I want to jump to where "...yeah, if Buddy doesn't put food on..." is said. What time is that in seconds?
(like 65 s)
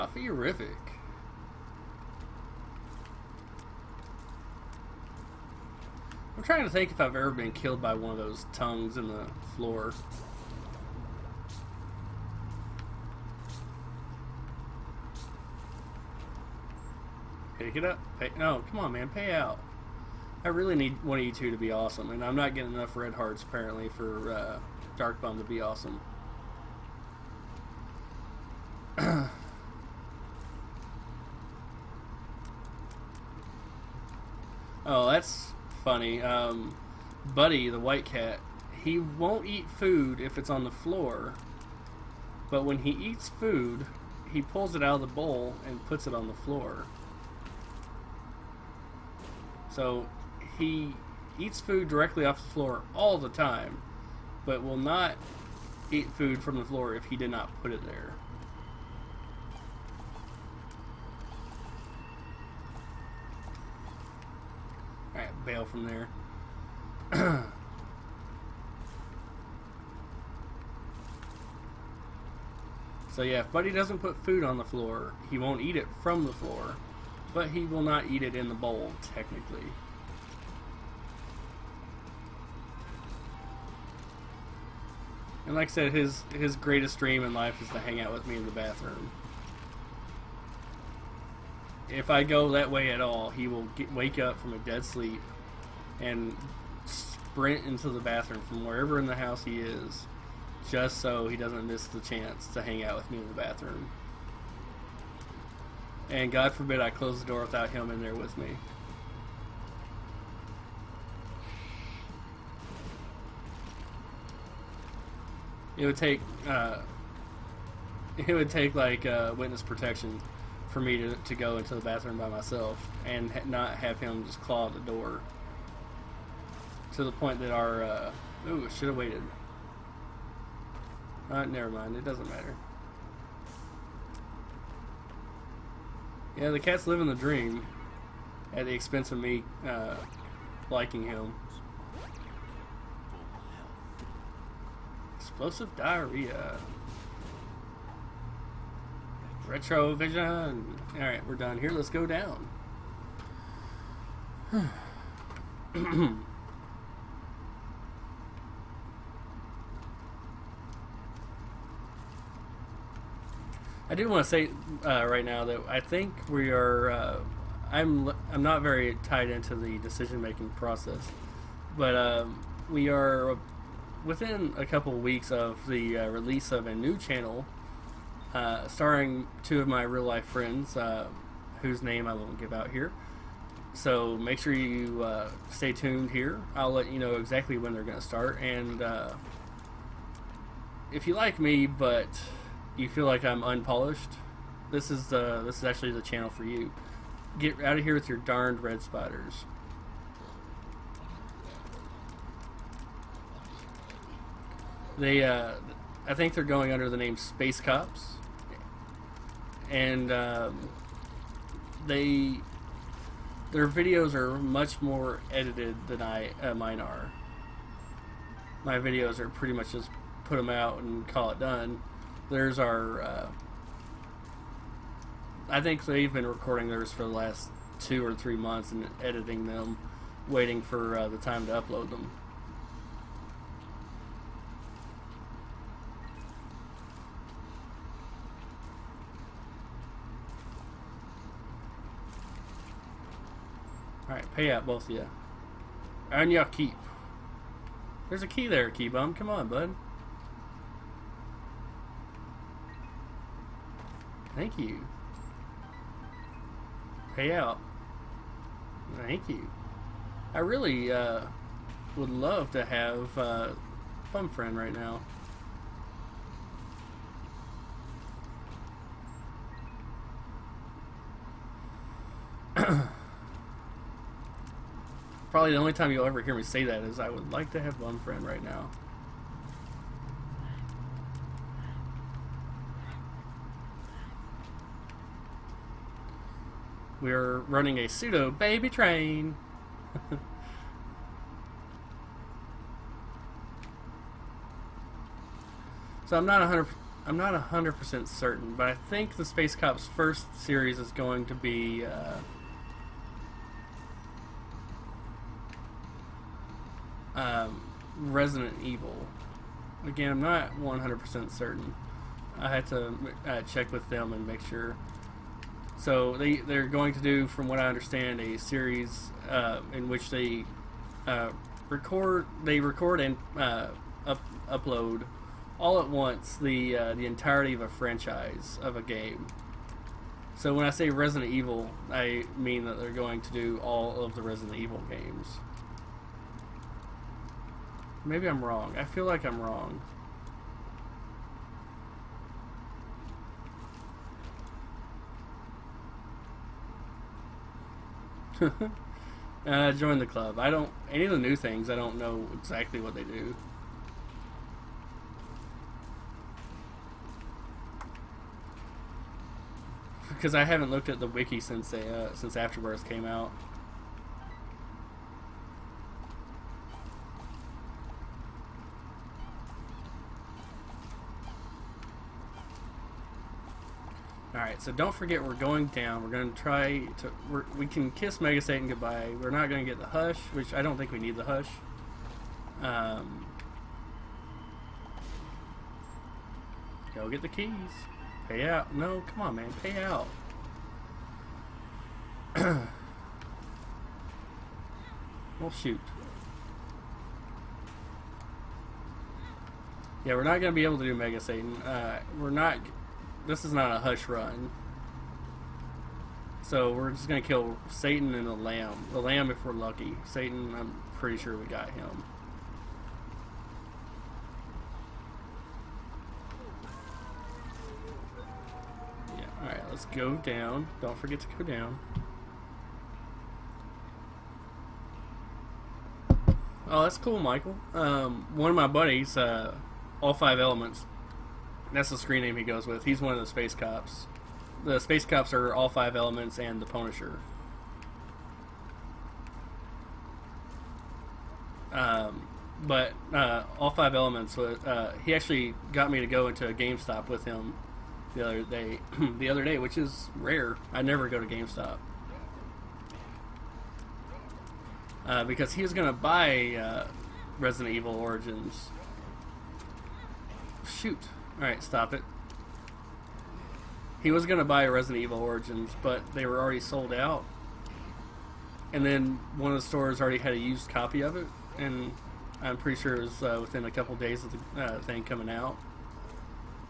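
73 s.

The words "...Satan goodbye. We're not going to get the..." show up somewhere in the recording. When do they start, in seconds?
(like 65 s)
378 s.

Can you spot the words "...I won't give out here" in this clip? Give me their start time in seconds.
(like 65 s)
182 s.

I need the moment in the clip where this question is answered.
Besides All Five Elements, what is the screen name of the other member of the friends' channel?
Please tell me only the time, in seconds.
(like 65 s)
436 s.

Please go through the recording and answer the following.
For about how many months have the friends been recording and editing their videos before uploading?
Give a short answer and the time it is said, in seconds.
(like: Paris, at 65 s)
two or three months, at 227 s.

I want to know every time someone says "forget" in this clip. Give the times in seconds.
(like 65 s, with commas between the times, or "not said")
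374 s, 420 s.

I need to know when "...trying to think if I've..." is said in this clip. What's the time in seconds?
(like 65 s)
6 s.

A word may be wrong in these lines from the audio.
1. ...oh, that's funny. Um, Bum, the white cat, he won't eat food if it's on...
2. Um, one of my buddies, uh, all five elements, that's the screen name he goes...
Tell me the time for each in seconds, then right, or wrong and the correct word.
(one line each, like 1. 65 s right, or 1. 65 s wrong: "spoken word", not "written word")
1. 28 s wrong: "Buddy", not "Bum"
2. 427 s right.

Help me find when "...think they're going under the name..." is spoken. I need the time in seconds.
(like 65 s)
206 s.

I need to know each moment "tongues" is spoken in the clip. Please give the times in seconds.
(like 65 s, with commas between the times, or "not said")
8 s.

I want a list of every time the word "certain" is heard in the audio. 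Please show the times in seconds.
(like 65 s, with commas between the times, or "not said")
298 s, 311 s.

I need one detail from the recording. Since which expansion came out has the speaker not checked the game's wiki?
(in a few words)
Afterbirth.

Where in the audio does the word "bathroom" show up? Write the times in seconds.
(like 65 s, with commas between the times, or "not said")
88 s, 97 s, 103 s, 121 s.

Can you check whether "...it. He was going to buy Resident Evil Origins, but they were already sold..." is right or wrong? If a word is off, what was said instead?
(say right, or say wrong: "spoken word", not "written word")
right.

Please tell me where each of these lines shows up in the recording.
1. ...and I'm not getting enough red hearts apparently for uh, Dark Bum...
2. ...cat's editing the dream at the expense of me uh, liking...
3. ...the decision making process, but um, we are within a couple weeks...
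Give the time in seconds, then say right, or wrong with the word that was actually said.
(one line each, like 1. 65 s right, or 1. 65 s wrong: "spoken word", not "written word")
1. 22 s right
2. 136 s wrong: "living", not "editing"
3. 169 s right.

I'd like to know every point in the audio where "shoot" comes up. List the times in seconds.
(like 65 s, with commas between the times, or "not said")
395 s, 460 s.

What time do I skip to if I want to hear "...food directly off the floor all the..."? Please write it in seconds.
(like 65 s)
51 s.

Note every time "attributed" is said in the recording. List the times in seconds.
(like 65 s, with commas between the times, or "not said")
not said.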